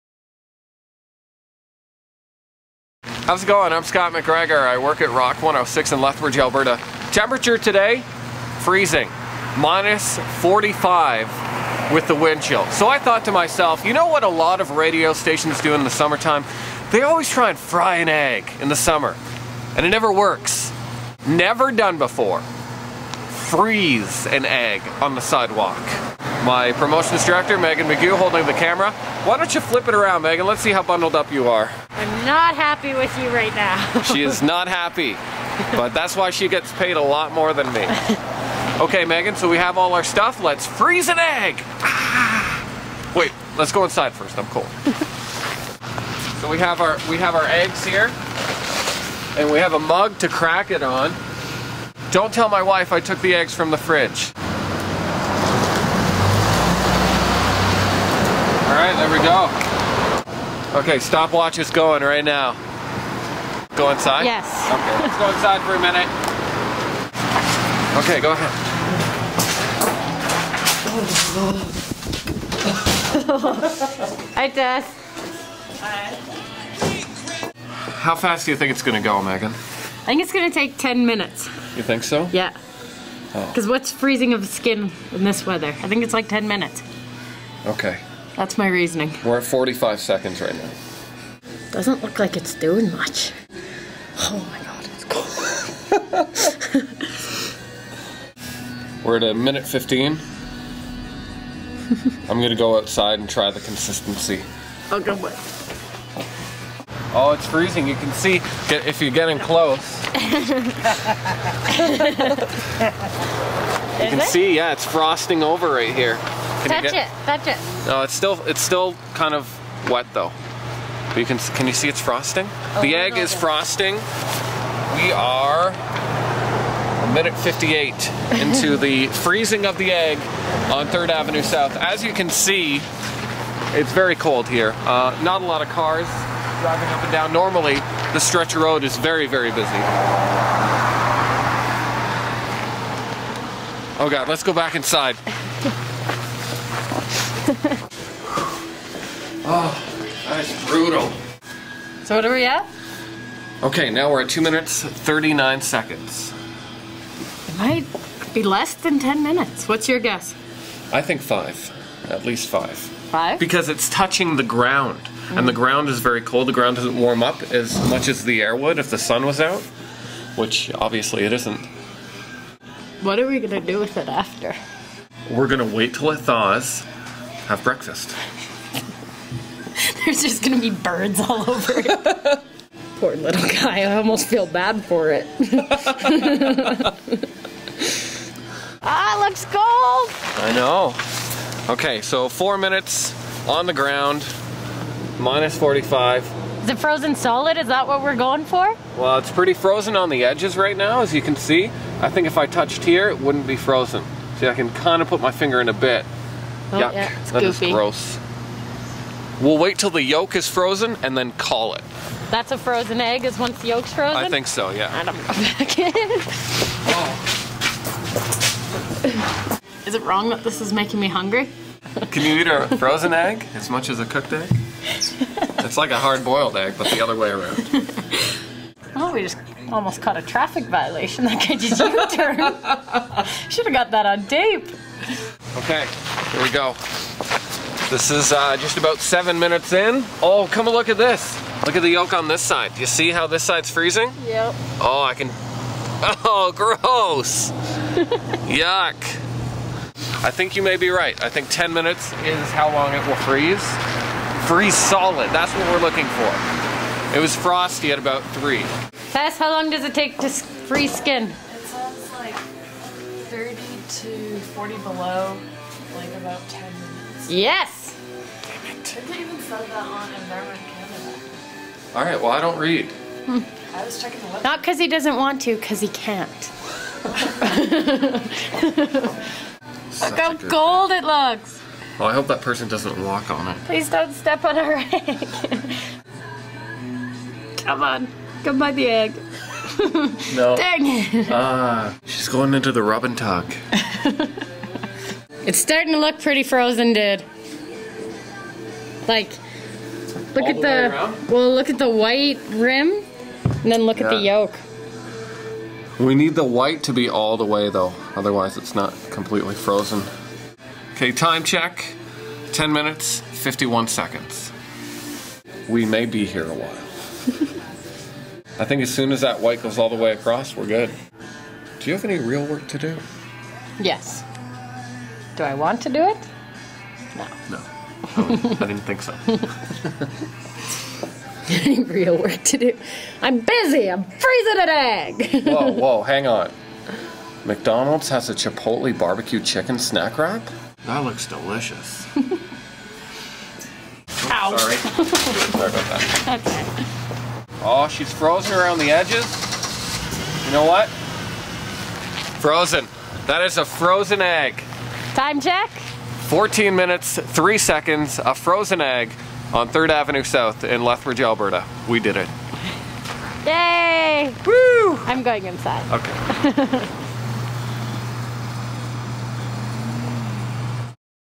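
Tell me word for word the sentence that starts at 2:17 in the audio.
Normally, the stretch of road is very, very busy.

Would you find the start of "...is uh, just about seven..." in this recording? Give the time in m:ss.
3:58.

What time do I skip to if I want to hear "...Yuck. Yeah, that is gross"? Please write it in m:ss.
3:26.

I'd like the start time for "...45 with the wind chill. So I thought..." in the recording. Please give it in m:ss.
0:10.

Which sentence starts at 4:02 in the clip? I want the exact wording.
You see how this side's freezing?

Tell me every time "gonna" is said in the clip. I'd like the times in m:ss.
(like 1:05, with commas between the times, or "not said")
1:42, 3:00.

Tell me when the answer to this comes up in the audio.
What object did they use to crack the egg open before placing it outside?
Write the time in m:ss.
0:49.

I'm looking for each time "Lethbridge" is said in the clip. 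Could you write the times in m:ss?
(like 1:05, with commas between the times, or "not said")
0:06, 6:00.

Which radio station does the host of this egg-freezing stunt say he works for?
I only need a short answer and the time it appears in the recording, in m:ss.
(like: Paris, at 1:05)
Rock 106, at 0:05.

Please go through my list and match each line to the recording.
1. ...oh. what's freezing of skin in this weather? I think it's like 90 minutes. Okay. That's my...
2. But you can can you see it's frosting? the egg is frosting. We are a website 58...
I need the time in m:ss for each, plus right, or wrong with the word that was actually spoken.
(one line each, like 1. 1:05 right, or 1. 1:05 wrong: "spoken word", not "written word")
1. 1:23 wrong: "10", not "90"
2. 2:01 wrong: "minute", not "website".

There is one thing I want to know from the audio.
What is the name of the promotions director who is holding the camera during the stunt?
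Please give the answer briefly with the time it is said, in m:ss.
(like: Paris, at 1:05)
Megan McGew, at 0:27.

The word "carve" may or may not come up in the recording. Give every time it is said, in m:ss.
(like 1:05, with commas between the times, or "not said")
not said.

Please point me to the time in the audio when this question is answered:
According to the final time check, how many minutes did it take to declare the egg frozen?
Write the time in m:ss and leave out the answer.
5:56.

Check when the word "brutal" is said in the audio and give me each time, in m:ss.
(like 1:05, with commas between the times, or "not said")
2:30.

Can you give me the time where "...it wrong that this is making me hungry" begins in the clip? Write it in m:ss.
3:39.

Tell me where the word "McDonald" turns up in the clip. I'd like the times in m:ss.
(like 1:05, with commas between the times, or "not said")
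5:37.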